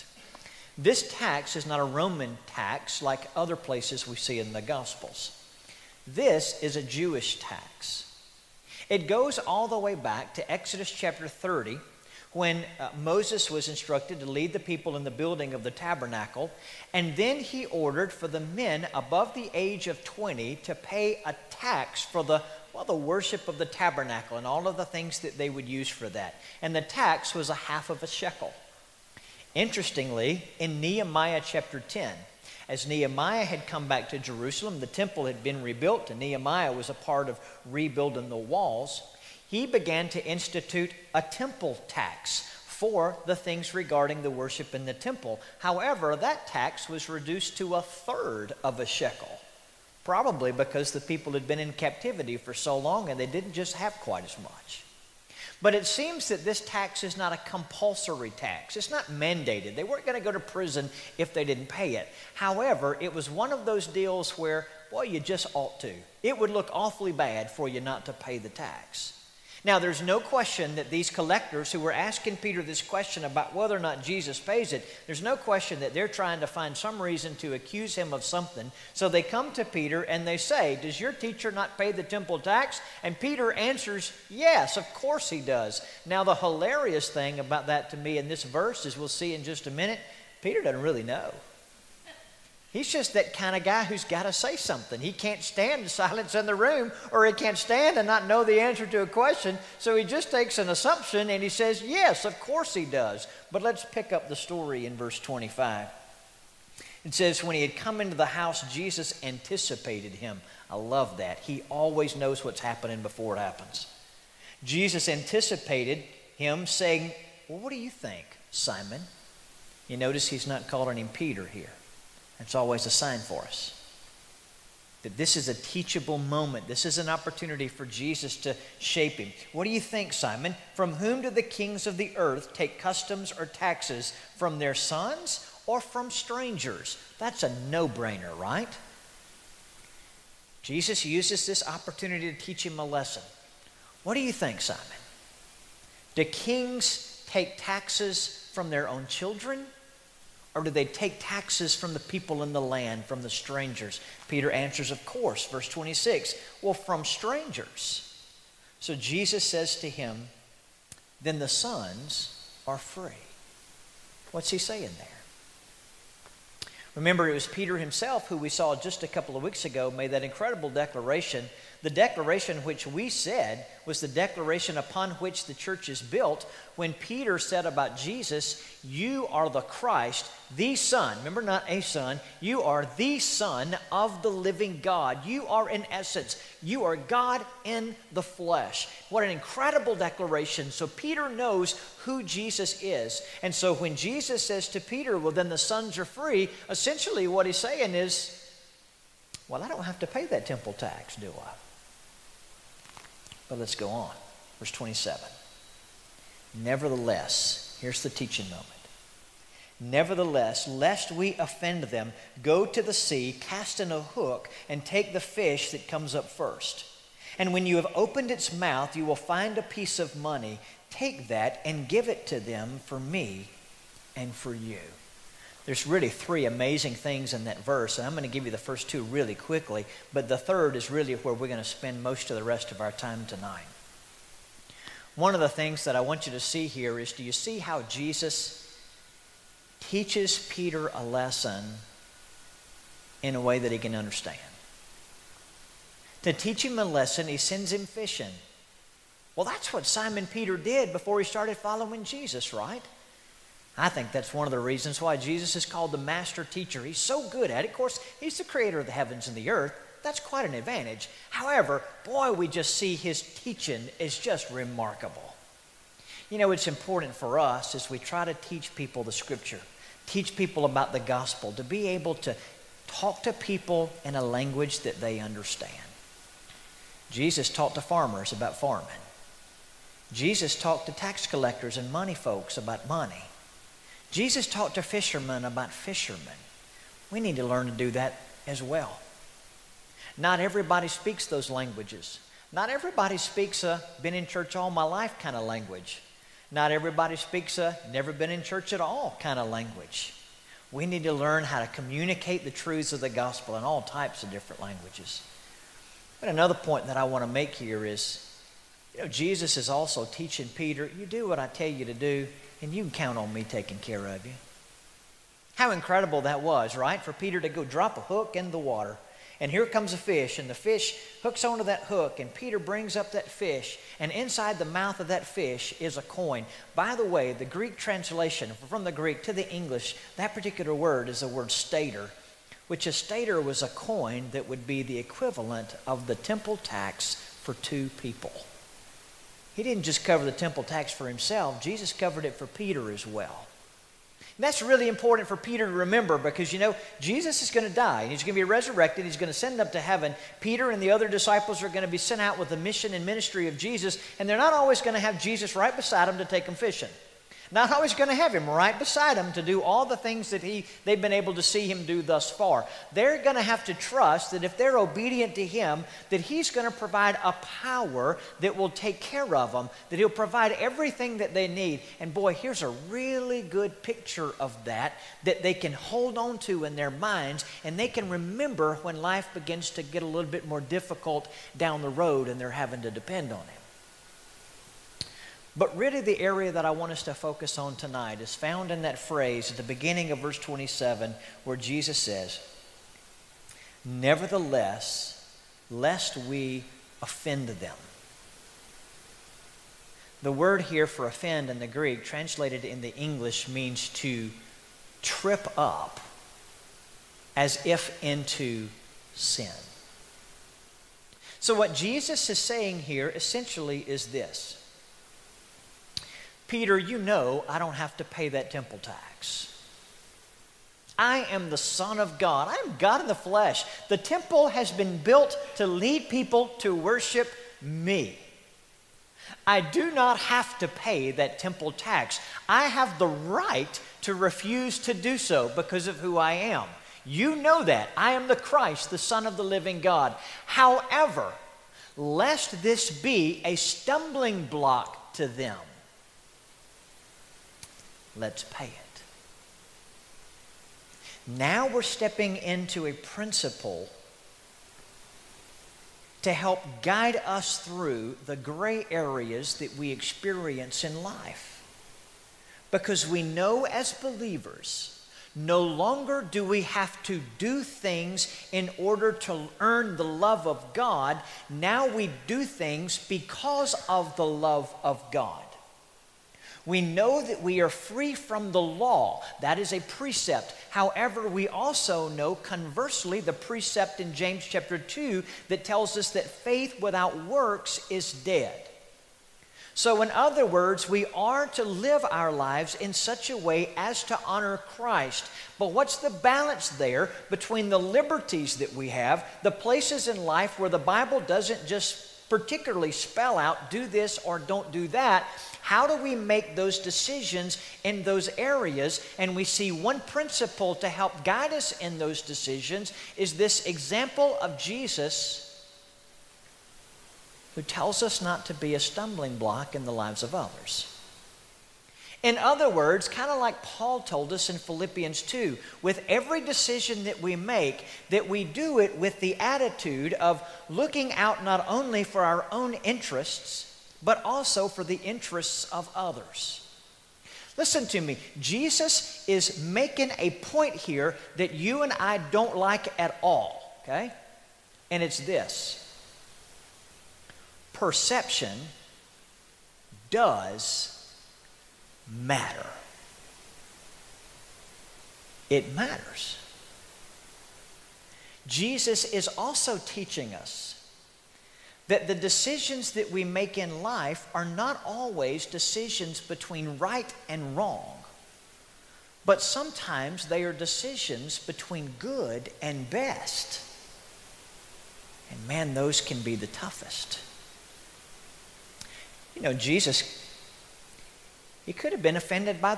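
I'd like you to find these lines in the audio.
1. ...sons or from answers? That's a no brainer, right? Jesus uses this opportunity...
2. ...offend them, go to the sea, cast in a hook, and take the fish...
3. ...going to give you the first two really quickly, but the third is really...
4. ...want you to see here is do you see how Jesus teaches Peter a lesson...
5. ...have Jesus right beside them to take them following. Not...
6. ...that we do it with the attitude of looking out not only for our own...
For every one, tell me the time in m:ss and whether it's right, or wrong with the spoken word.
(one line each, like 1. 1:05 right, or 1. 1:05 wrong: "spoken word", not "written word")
1. 2:14 wrong: "strangers", not "answers"
2. 3:31 right
3. 3:48 right
4. 3:56 right
5. 5:54 wrong: "fishing", not "following"
6. 8:48 right.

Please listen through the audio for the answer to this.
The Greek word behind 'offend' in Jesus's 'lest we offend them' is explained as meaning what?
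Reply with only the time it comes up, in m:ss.
6:43.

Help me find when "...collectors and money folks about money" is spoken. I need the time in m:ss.
4:41.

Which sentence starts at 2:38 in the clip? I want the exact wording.
So Jesus says to him, Then the sons are free.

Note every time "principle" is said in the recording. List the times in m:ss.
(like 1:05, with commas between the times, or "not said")
7:32, 8:29.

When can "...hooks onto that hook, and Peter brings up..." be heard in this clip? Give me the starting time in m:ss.
5:21.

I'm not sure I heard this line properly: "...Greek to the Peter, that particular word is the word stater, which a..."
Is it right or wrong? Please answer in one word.
wrong.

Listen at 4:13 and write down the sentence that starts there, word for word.
I think that's one of the reasons why Jesus is called the master teacher.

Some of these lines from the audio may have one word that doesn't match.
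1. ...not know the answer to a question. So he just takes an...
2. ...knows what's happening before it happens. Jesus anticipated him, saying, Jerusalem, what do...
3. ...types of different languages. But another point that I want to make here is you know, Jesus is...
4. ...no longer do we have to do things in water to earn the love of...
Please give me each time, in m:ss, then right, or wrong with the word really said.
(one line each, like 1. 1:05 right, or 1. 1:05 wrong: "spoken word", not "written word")
1. 1:38 right
2. 1:52 wrong: "Well", not "Jerusalem"
3. 5:03 right
4. 7:45 wrong: "order", not "water".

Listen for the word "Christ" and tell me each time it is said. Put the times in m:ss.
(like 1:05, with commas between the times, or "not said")
2:59, 7:18, 8:14.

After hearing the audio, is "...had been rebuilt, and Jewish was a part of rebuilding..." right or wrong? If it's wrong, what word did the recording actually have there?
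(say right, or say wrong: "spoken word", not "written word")
wrong: "Nehemiah", not "Jewish".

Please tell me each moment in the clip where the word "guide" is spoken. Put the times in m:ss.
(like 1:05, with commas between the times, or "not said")
7:36, 8:31.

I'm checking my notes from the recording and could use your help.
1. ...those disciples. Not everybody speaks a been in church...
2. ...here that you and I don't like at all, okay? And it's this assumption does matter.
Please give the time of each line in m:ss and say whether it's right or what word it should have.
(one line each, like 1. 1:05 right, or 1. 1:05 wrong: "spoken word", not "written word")
1. 4:51 wrong: "languages", not "disciples"
2. 9:00 wrong: "perception", not "assumption".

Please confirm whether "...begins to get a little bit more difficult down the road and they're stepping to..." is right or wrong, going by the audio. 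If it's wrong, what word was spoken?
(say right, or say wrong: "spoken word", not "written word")
wrong: "having", not "stepping".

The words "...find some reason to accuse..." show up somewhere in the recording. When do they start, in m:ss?
1:16.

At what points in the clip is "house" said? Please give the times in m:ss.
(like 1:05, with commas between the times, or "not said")
1:48.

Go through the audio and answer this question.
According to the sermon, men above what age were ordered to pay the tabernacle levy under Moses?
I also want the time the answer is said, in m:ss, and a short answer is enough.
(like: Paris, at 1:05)
20, at 0:19.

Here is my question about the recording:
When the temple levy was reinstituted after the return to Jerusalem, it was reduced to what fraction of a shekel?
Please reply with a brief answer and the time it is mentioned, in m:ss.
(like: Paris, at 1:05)
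A third, at 0:47.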